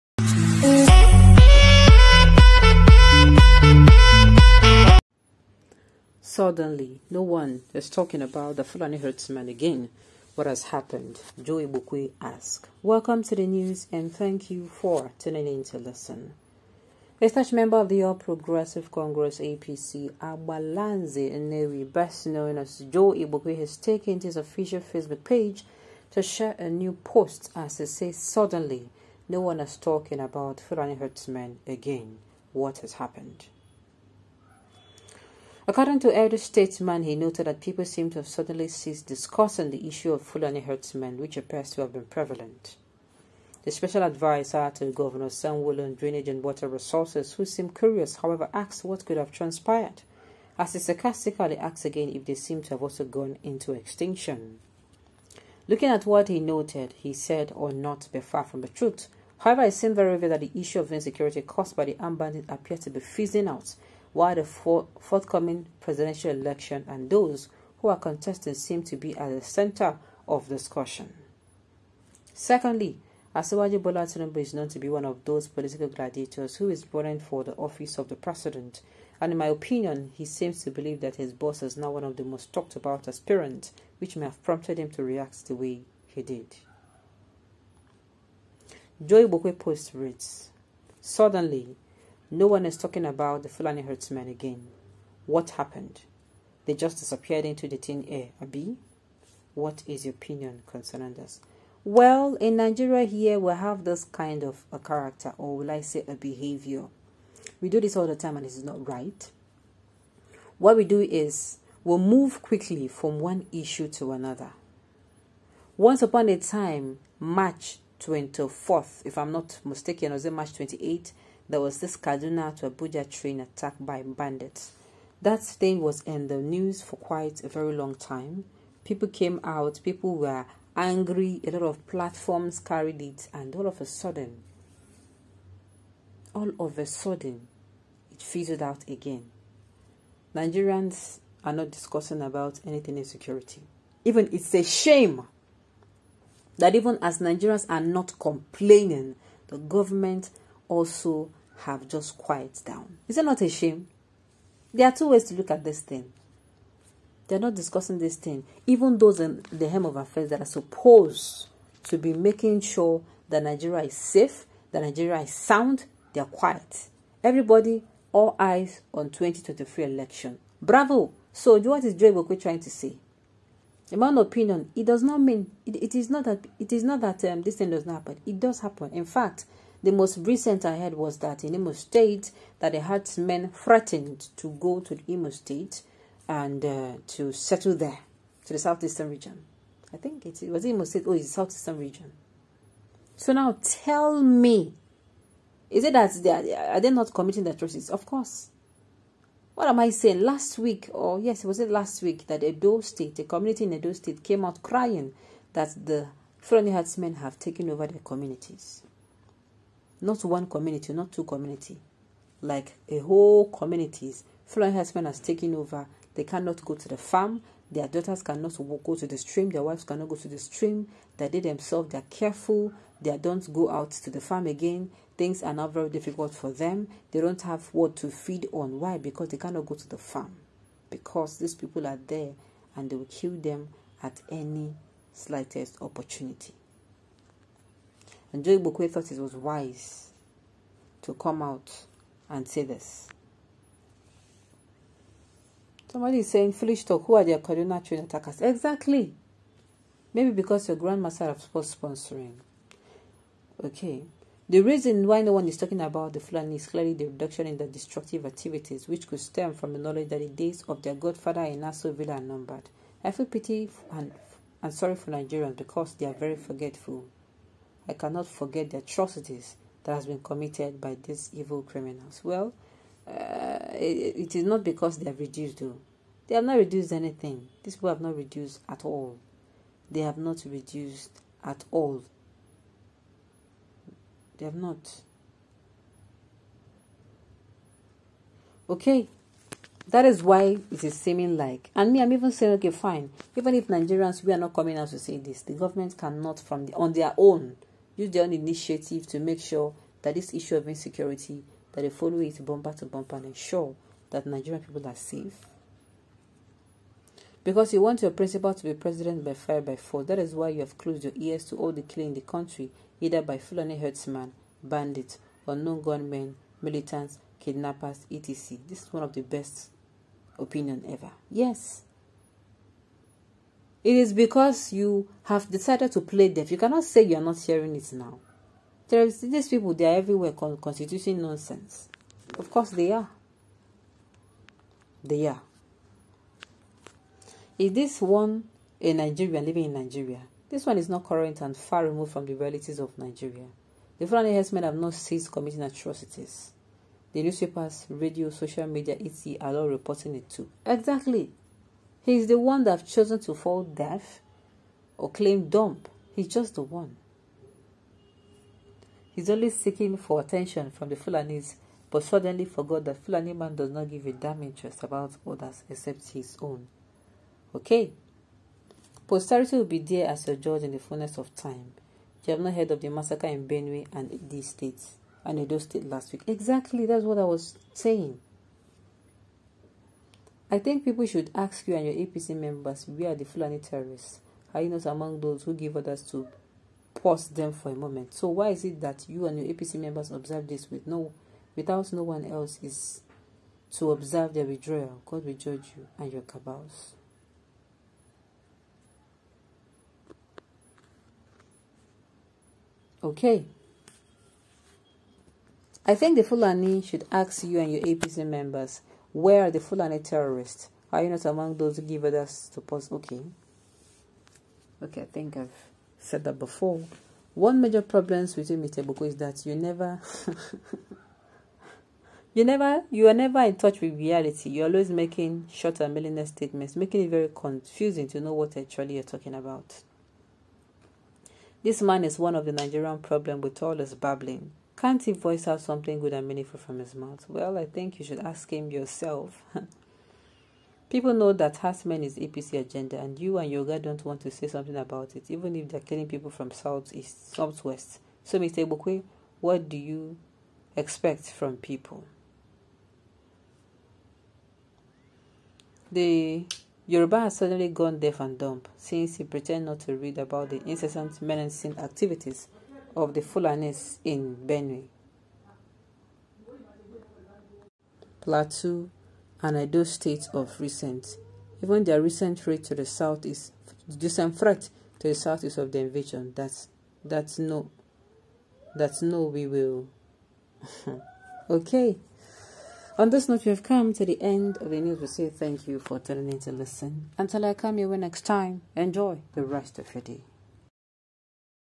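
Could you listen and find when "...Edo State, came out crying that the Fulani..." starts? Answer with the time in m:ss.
3:23.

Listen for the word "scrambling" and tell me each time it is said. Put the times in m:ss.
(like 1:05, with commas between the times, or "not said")
not said.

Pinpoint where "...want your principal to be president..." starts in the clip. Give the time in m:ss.
5:07.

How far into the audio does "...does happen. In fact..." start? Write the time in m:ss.
2:58.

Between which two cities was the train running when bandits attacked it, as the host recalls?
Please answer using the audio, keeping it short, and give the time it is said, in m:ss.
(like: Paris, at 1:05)
Kaduna to Abuja, at 2:01.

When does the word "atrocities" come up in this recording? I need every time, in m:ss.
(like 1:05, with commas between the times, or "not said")
3:17, 4:28, 5:45.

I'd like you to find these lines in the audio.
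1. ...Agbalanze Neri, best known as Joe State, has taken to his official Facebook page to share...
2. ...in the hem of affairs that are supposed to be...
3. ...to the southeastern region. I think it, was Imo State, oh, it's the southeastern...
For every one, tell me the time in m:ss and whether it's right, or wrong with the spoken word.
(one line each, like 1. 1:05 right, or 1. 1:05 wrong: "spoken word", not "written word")
1. 0:20 wrong: "Igbokwe", not "State"
2. 2:39 right
3. 3:08 right.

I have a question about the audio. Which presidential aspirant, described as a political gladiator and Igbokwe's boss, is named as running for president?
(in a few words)
Bola Tinubu.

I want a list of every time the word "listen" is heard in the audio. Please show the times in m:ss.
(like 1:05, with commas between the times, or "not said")
0:15, 8:06.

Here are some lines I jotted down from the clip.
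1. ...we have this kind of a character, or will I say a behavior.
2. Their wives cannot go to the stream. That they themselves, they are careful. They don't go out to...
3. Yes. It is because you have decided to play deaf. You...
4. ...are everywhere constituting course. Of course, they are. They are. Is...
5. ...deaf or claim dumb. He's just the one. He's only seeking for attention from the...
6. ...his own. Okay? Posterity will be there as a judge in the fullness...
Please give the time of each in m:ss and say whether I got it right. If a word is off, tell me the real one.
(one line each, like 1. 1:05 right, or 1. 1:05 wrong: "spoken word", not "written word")
1. 1:43 right
2. 3:39 right
3. 5:21 right
4. 5:29 wrong: "nonsense", not "course"
5. 5:53 right
6. 6:06 right.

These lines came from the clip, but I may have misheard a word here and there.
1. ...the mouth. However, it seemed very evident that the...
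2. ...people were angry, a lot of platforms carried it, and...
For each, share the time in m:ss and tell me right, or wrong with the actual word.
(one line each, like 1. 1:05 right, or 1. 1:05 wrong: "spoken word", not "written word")
1. 0:58 wrong: "truth", not "mouth"
2. 2:09 right.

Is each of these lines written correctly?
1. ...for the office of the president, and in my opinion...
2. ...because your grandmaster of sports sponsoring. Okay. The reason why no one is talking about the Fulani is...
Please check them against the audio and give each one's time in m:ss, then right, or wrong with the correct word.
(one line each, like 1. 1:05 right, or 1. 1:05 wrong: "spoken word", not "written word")
1. 1:17 right
2. 4:10 right.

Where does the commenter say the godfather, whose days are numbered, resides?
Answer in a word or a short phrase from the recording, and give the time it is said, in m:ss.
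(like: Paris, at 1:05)
Aso Villa, at 4:21.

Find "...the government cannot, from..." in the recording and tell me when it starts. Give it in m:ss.
4:55.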